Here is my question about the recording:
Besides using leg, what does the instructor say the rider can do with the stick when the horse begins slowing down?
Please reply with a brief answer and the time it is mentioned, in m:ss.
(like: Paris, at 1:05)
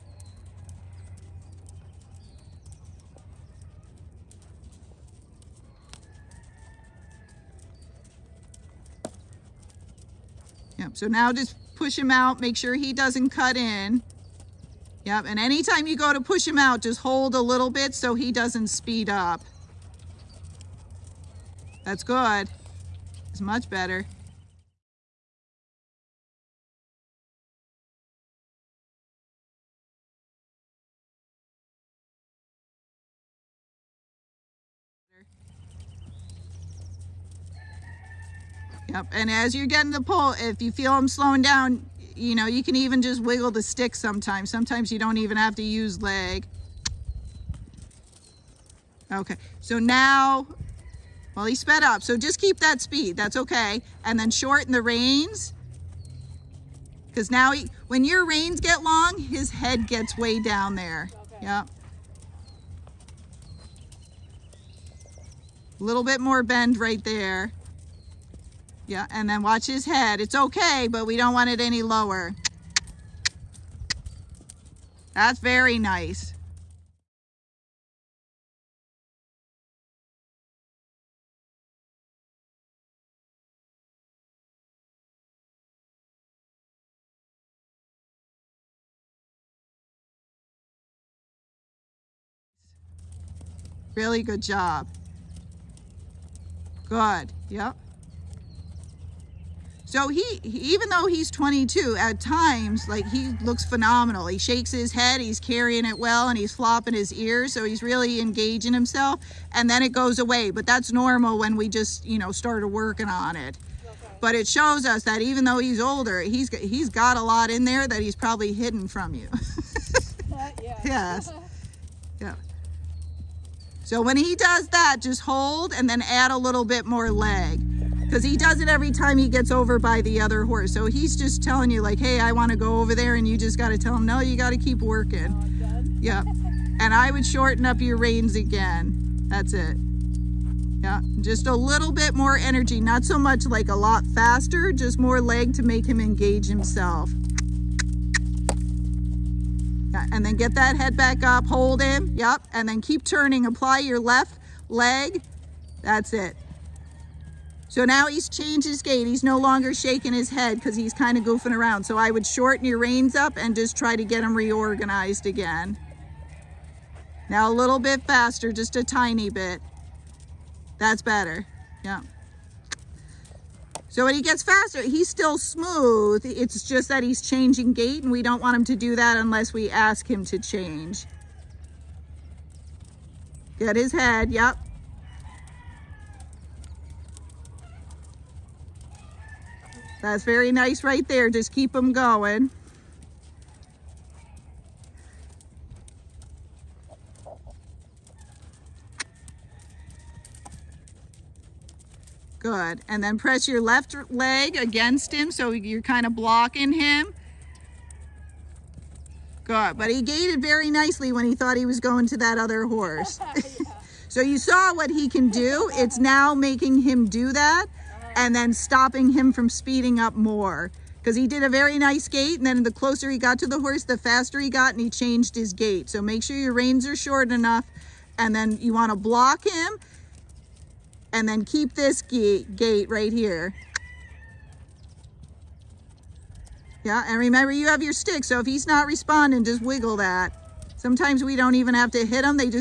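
wiggle the stick, at 0:43.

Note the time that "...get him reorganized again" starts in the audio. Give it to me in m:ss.
2:44.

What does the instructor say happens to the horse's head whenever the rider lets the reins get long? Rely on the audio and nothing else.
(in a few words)
gets way down.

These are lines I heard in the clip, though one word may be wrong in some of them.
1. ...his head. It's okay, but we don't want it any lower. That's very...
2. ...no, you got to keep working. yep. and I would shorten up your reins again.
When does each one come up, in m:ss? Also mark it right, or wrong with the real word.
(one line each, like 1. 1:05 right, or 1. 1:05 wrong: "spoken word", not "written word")
1. 1:09 right
2. 2:14 right.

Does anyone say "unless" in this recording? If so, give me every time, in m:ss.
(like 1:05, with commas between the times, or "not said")
2:59.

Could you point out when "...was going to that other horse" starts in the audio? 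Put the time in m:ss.
3:31.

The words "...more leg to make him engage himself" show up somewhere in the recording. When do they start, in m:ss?
2:24.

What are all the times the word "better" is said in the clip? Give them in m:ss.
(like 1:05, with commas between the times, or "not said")
0:23, 2:51.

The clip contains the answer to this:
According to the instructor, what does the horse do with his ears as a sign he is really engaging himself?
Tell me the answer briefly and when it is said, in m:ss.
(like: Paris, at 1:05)
flopping his ears, at 1:46.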